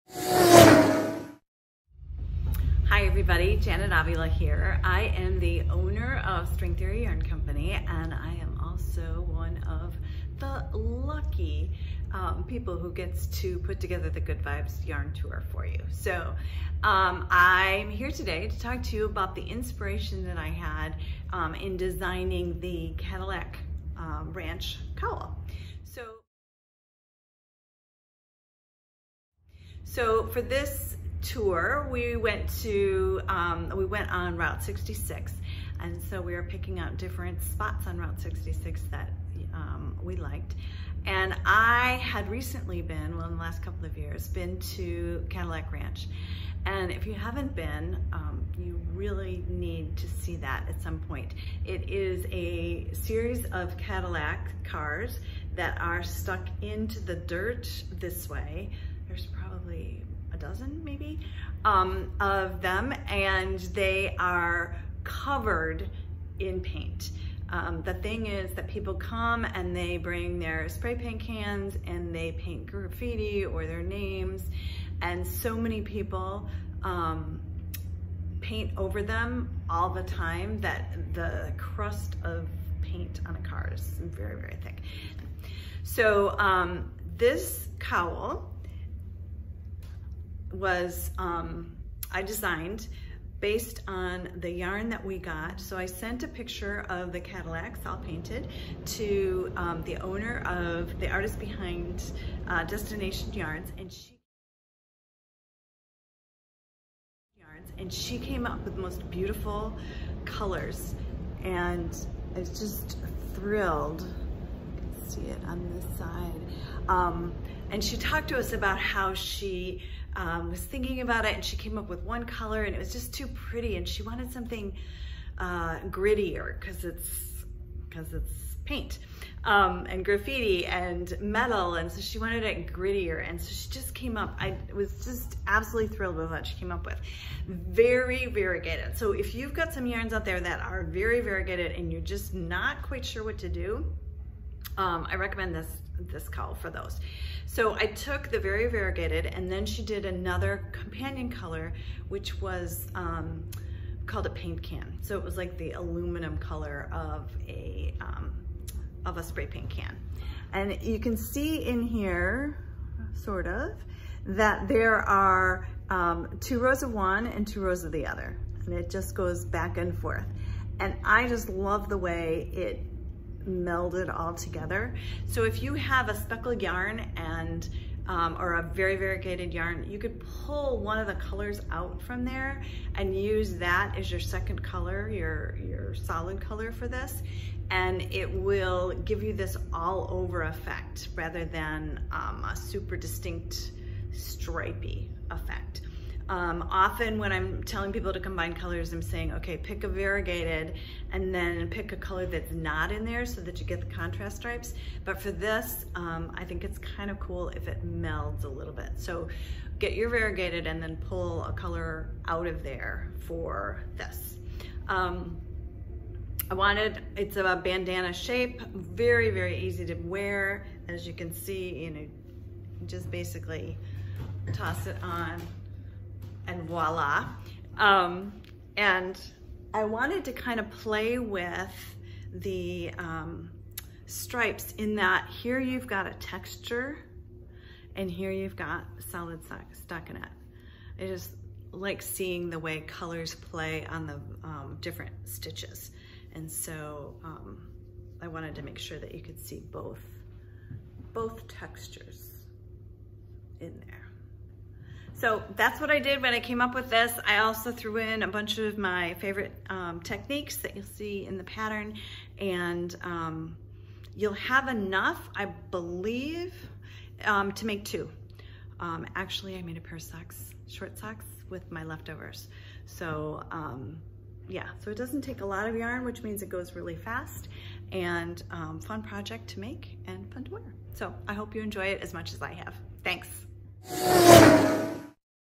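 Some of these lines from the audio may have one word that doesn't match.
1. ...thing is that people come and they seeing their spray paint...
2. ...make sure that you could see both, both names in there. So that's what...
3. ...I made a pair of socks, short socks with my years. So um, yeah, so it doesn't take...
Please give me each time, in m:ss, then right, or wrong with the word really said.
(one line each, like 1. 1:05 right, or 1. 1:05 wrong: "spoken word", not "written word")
1. 1:07 wrong: "bring", not "seeing"
2. 4:08 wrong: "textures", not "names"
3. 4:29 wrong: "leftovers", not "years".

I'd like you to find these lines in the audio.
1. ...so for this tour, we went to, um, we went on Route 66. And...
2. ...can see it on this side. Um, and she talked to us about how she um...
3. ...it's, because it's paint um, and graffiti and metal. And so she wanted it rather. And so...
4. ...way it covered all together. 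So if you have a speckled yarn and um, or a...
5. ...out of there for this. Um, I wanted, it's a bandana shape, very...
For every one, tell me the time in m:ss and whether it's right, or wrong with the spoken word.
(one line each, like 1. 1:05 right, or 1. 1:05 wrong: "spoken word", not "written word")
1. 0:29 right
2. 1:54 right
3. 2:06 wrong: "grittier", not "rather"
4. 2:51 wrong: "melded", not "covered"
5. 3:32 right.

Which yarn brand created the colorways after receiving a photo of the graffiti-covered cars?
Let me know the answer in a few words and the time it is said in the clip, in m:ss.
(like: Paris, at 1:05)
Destination Yarns, at 1:42.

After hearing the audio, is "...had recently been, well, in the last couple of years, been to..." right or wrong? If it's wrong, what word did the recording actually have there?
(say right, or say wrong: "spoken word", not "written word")
right.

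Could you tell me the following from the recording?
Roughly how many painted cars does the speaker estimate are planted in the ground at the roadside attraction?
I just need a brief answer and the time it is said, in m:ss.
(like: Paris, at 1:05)
a dozen, at 1:00.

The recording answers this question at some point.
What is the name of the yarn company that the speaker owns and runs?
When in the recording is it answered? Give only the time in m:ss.
0:06.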